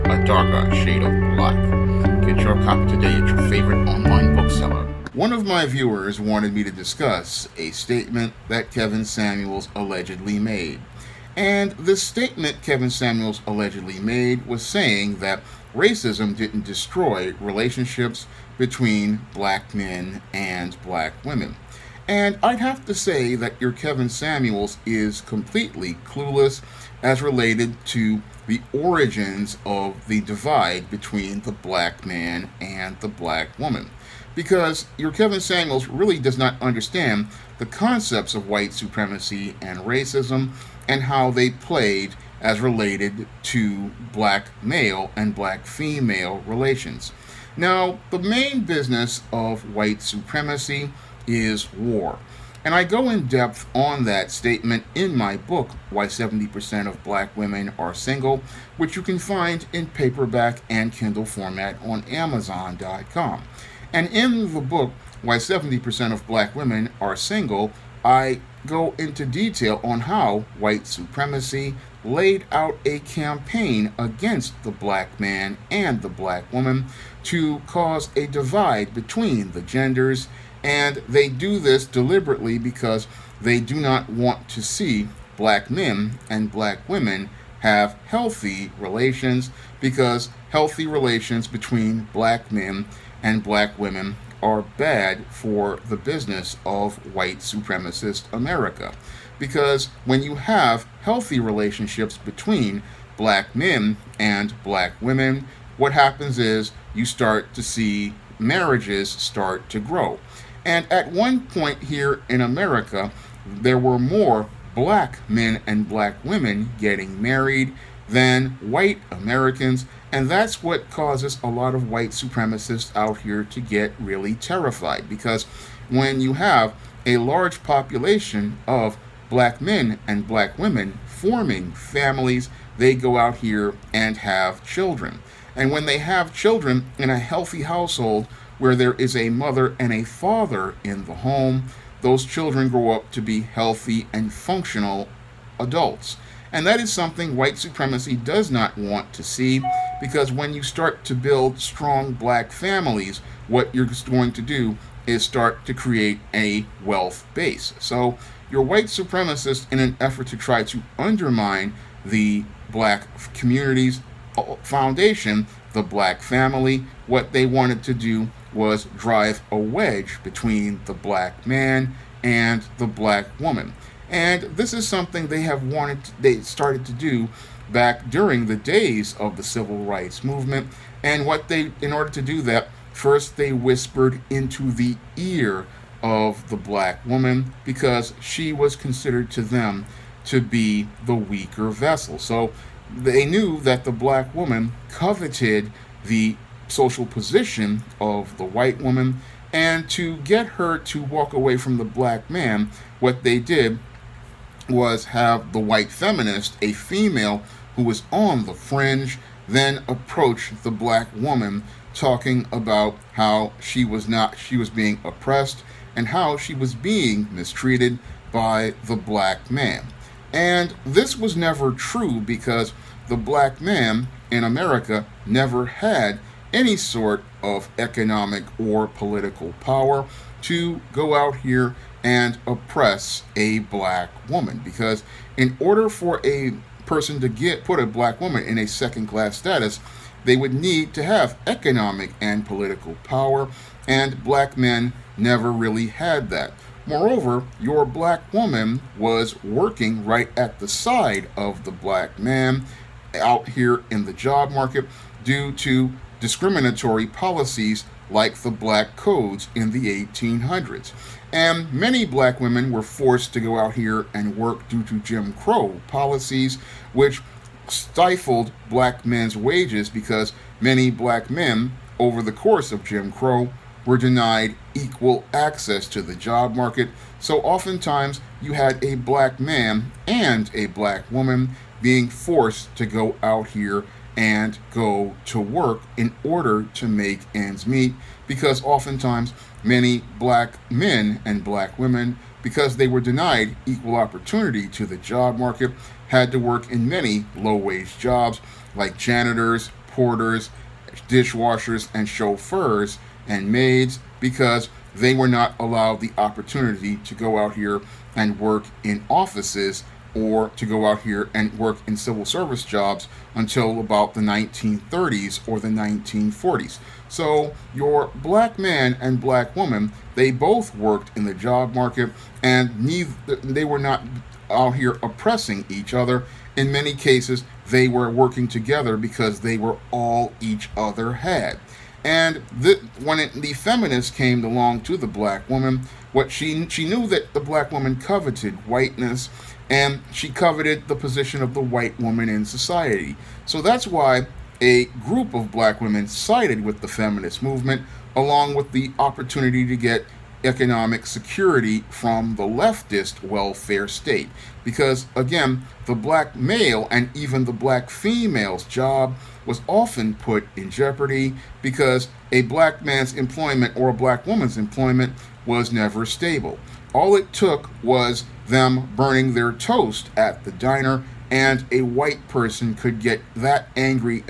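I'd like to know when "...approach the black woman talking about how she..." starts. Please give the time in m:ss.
3:29.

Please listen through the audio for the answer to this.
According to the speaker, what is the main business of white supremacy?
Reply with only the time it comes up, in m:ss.
0:51.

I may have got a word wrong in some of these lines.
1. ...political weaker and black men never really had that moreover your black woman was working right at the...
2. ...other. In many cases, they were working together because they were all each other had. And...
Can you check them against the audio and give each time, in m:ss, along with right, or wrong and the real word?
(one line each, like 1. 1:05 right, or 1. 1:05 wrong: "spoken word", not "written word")
1. 4:02 wrong: "power", not "weaker"
2. 5:25 right.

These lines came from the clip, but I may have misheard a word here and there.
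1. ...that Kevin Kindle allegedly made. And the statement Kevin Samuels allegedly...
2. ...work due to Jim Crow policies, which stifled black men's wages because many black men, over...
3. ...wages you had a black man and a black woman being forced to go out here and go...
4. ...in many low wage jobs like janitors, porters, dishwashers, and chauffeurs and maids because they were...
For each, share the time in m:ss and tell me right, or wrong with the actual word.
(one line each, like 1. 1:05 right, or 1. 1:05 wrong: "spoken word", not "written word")
1. 0:08 wrong: "Samuels", not "Kindle"
2. 4:24 right
3. 4:37 wrong: "oftentimes", not "wages"
4. 4:56 right.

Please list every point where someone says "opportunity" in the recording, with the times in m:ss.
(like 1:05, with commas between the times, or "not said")
4:53, 5:06, 5:48.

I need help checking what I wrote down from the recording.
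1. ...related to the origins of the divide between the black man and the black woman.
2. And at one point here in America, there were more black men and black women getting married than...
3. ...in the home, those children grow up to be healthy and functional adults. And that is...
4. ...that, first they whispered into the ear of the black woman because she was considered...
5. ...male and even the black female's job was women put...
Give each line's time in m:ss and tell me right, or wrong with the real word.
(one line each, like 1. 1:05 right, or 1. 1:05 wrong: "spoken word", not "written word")
1. 0:27 right
2. 1:50 right
3. 2:20 right
4. 3:02 right
5. 5:56 wrong: "often", not "women".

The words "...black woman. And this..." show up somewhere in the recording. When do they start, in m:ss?
2:52.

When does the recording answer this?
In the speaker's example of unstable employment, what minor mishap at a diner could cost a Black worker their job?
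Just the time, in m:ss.
6:08.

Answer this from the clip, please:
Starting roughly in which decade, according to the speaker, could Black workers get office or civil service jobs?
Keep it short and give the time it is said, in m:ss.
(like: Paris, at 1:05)
1930s, at 5:14.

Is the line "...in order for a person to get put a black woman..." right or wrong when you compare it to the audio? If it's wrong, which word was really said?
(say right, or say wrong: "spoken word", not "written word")
right.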